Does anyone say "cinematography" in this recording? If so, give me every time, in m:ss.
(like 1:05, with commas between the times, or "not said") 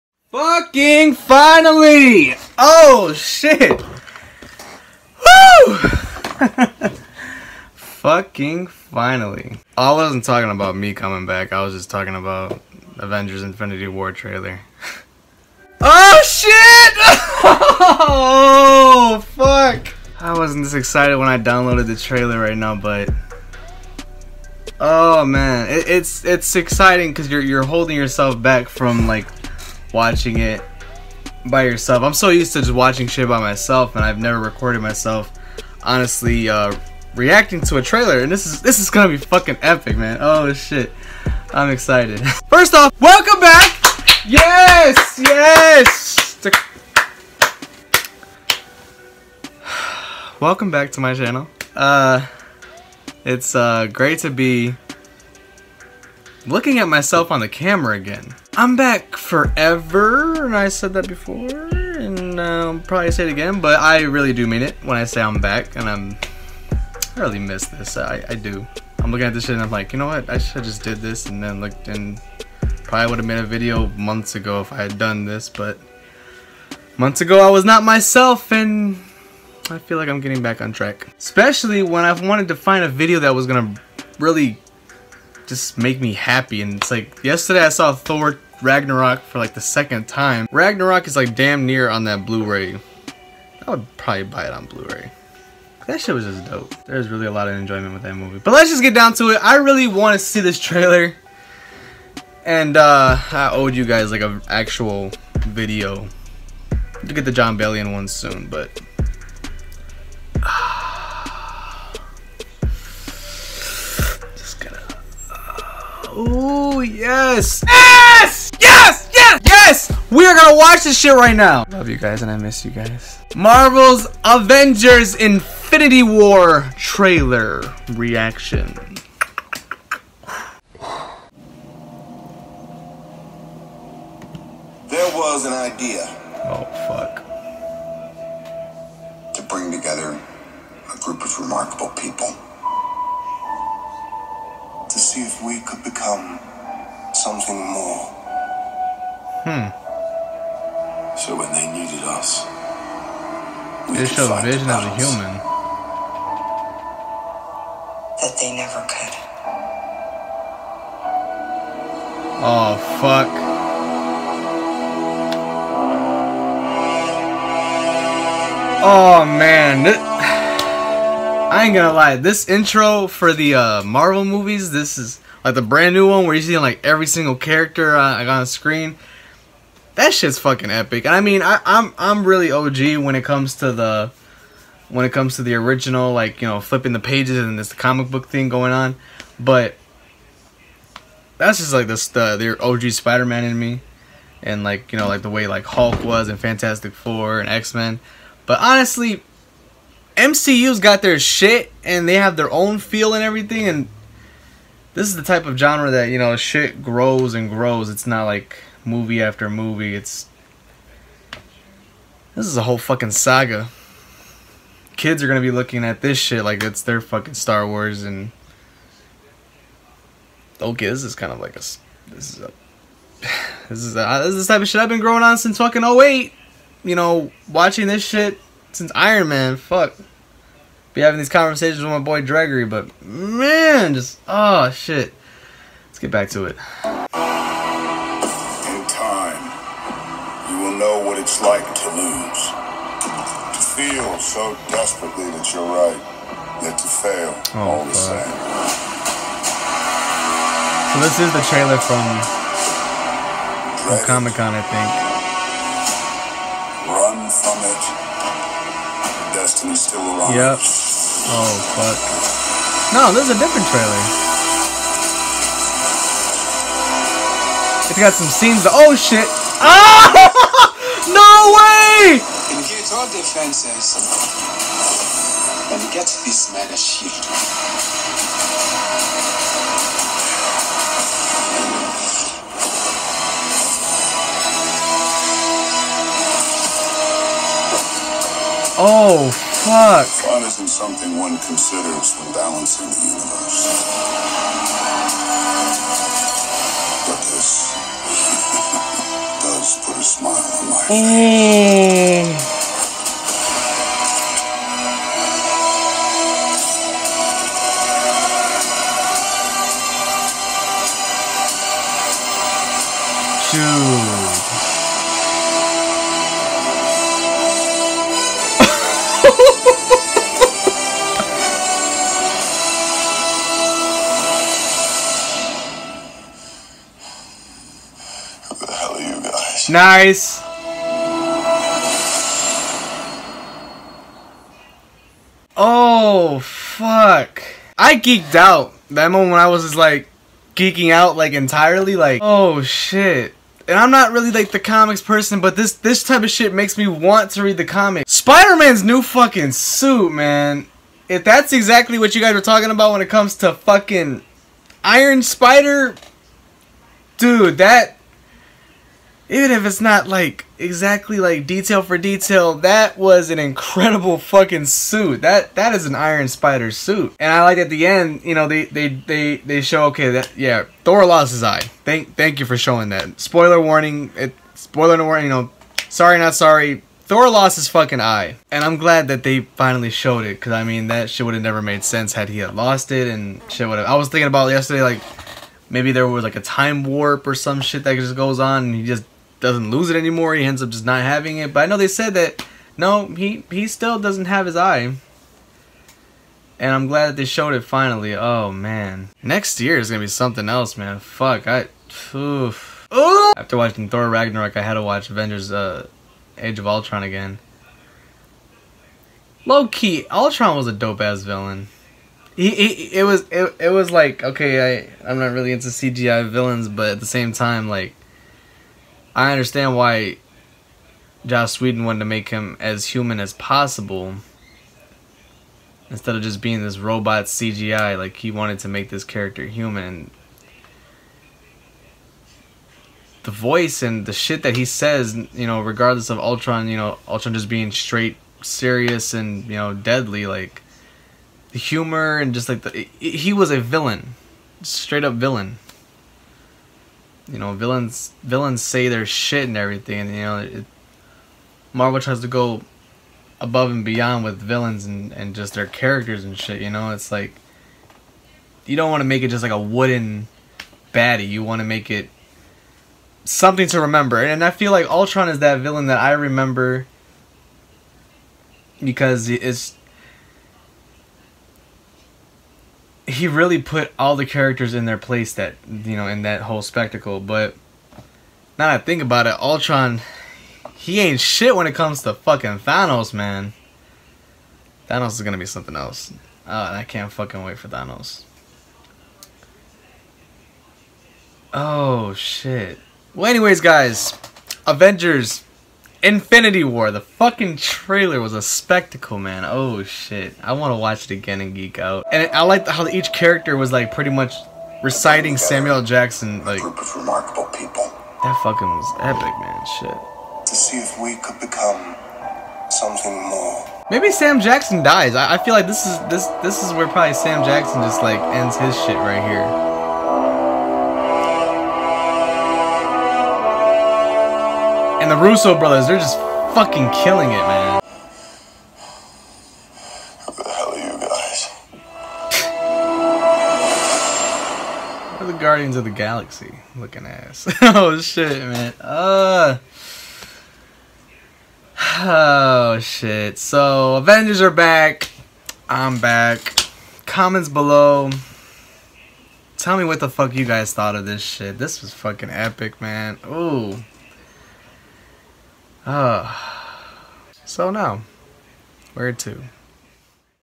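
not said.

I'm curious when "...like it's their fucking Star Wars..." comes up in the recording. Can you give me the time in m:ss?
3:36.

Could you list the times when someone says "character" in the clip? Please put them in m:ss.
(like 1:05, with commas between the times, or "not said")
2:57, 7:09, 7:35, 7:54, 8:23.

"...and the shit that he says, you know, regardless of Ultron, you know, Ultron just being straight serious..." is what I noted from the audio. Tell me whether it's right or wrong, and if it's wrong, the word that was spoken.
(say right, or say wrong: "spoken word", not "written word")
right.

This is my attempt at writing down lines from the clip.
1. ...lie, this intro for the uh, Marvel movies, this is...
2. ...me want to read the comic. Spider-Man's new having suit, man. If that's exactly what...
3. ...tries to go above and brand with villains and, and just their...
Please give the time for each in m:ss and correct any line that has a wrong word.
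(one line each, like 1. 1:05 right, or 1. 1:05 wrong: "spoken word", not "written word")
1. 2:51 right
2. 5:46 wrong: "fucking", not "having"
3. 7:32 wrong: "beyond", not "brand".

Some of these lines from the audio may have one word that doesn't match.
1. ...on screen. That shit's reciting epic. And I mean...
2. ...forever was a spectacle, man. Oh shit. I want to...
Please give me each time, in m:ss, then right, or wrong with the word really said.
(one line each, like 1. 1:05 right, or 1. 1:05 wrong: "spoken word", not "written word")
1. 2:58 wrong: "fucking", not "reciting"
2. 8:17 wrong: "trailer", not "forever".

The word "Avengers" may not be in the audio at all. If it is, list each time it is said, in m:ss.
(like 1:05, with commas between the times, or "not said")
0:12, 2:04, 6:45, 8:14, 9:03.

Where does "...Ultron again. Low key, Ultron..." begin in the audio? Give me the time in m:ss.
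6:46.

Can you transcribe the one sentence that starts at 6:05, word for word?
That that is an Iron Spider suit.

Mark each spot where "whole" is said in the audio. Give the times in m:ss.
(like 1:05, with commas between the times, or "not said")
3:32, 7:56.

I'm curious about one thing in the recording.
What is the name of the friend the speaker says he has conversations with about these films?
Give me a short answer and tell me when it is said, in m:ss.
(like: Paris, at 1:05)
Gregory, at 3:52.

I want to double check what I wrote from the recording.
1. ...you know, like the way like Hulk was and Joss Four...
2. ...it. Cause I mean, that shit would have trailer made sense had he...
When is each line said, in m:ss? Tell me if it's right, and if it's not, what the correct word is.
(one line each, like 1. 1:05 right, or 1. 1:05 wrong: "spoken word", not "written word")
1. 3:14 wrong: "Fantastic", not "Joss"
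2. 6:20 wrong: "never", not "trailer".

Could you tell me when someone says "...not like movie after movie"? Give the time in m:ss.
3:28.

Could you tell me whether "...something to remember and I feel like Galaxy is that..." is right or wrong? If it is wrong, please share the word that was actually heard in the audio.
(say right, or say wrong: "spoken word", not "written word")
wrong: "Ultron", not "Galaxy".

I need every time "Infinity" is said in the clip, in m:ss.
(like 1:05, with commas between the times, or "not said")
0:13, 2:05, 8:16.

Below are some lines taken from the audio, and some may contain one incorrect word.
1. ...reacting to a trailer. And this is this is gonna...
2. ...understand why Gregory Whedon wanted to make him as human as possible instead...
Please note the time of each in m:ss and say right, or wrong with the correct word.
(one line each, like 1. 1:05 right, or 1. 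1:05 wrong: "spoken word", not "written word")
1. 0:37 right
2. 6:59 wrong: "Joss", not "Gregory".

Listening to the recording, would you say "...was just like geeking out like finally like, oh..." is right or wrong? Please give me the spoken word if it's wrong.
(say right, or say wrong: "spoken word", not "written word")
wrong: "entirely", not "finally".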